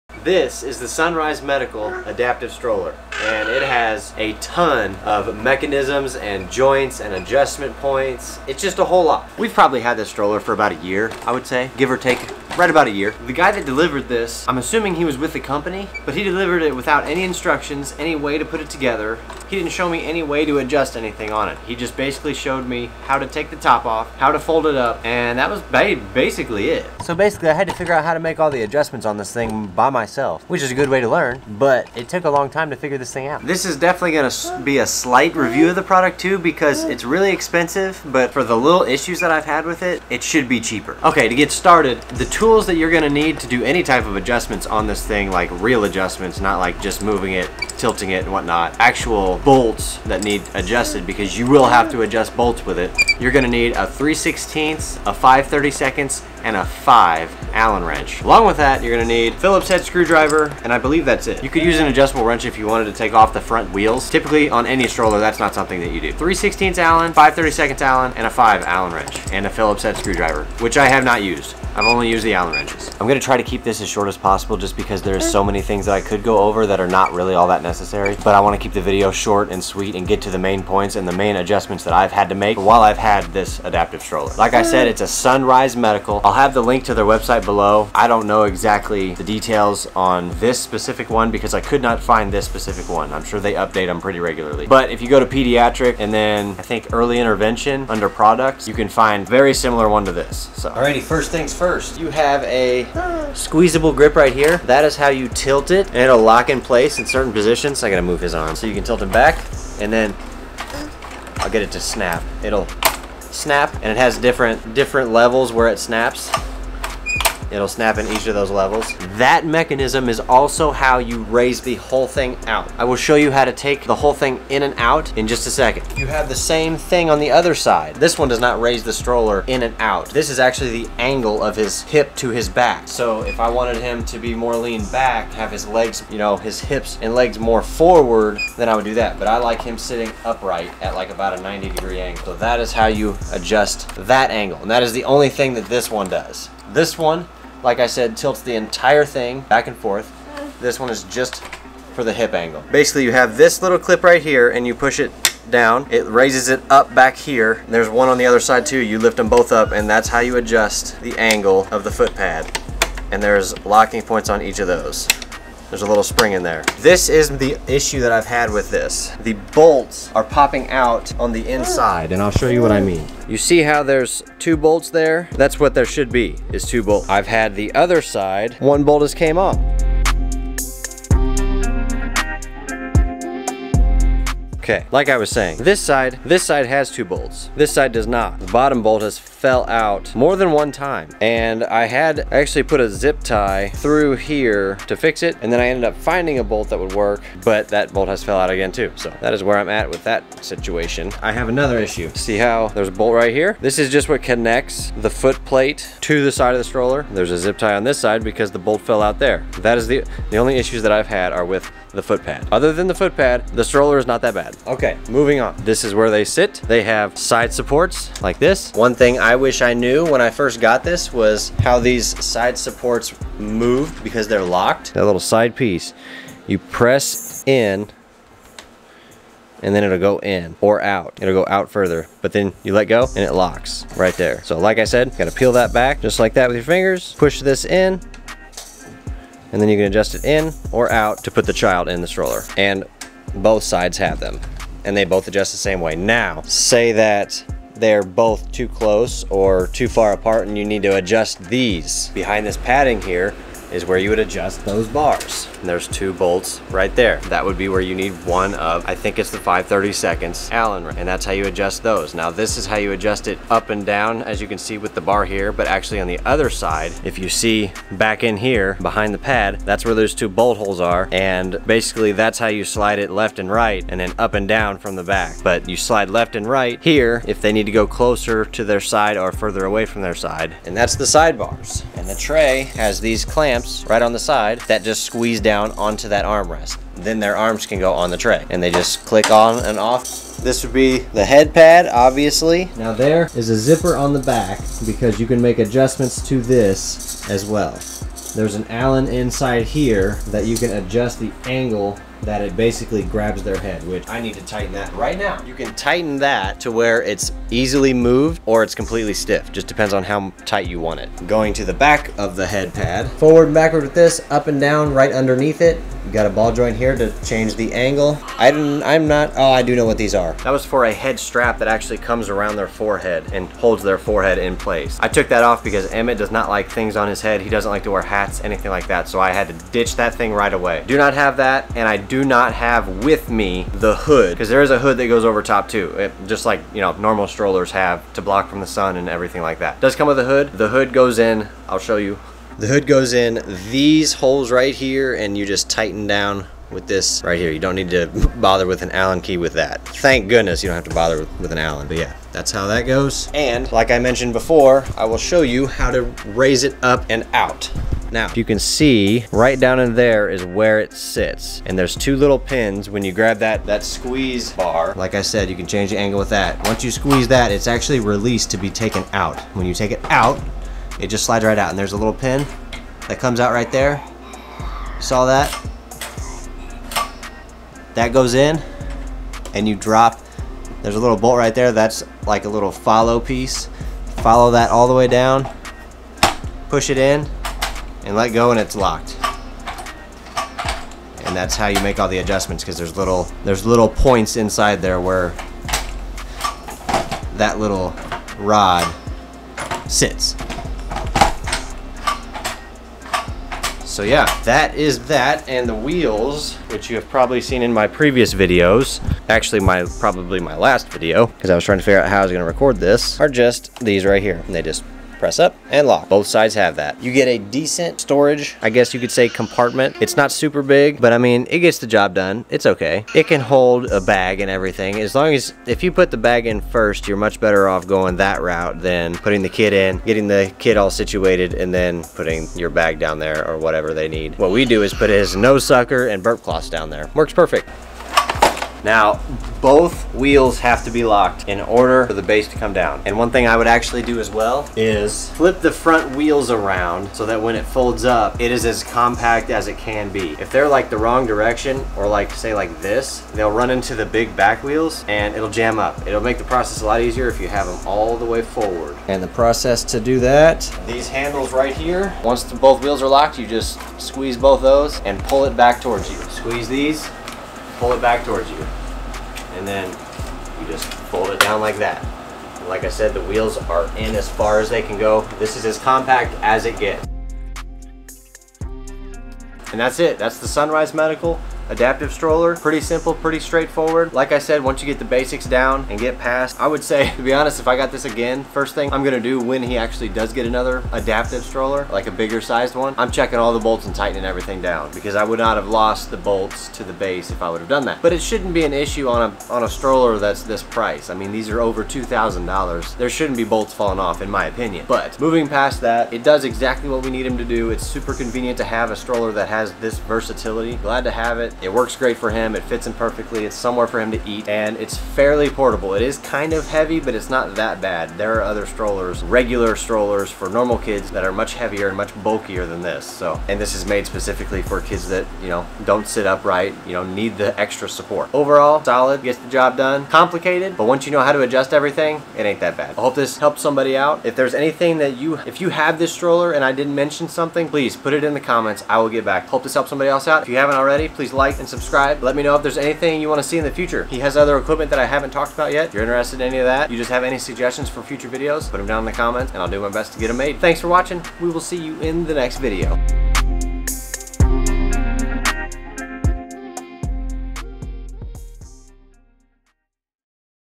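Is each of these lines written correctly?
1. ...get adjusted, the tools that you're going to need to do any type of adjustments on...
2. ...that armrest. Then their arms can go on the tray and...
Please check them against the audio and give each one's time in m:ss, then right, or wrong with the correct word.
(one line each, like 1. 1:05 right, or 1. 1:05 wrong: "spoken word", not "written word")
1. 0:41 wrong: "started", not "adjusted"
2. 4:46 right.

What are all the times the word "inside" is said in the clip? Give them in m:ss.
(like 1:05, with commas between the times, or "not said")
2:51, 4:59, 6:34.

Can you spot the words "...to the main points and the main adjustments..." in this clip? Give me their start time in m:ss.
1:20.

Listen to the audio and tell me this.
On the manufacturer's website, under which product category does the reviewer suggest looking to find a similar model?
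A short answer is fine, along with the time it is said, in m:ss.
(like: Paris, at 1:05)
Pediatric, at 1:35.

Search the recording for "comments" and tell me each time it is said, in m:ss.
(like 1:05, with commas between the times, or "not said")
8:58, 9:09.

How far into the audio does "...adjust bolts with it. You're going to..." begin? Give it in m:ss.
0:52.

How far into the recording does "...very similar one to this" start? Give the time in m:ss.
1:39.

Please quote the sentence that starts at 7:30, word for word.
If they're like the wrong direction or like say like this, they'll run into the big back wheels and it'll jam up.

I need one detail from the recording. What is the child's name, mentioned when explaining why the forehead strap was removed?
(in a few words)
Emmett.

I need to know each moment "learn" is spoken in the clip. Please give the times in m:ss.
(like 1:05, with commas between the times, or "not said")
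0:31.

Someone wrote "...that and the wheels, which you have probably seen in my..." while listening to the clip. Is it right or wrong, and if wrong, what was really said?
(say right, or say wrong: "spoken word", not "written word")
right.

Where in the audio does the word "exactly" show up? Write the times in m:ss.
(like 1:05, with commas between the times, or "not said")
1:28, 8:26.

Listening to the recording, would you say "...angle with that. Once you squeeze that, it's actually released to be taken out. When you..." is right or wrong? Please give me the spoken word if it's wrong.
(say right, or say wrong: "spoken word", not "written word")
right.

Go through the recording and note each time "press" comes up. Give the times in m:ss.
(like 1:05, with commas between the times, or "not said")
3:46, 6:55.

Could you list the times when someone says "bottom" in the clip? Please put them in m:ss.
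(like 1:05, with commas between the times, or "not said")
3:08.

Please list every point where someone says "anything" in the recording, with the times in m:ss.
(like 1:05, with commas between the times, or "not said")
0:20, 5:28, 8:54, 9:02.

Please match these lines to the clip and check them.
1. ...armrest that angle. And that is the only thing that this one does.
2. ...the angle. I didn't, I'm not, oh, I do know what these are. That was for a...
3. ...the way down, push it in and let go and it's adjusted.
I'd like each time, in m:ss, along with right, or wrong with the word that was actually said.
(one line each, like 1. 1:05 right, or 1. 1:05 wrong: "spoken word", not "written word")
1. 2:23 wrong: "adjust", not "armrest"
2. 5:17 right
3. 6:24 wrong: "locked", not "adjusted".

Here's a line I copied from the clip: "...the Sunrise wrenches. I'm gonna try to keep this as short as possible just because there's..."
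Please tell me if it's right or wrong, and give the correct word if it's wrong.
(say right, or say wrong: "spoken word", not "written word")
wrong: "Allen", not "Sunrise".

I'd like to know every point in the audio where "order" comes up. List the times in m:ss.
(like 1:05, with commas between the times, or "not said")
7:21.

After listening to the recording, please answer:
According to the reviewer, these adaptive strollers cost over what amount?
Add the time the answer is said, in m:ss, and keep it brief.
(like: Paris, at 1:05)
$2,000, at 8:21.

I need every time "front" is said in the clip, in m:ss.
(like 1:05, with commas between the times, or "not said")
1:03, 7:25.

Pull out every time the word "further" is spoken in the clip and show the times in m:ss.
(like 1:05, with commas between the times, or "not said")
3:51, 4:39.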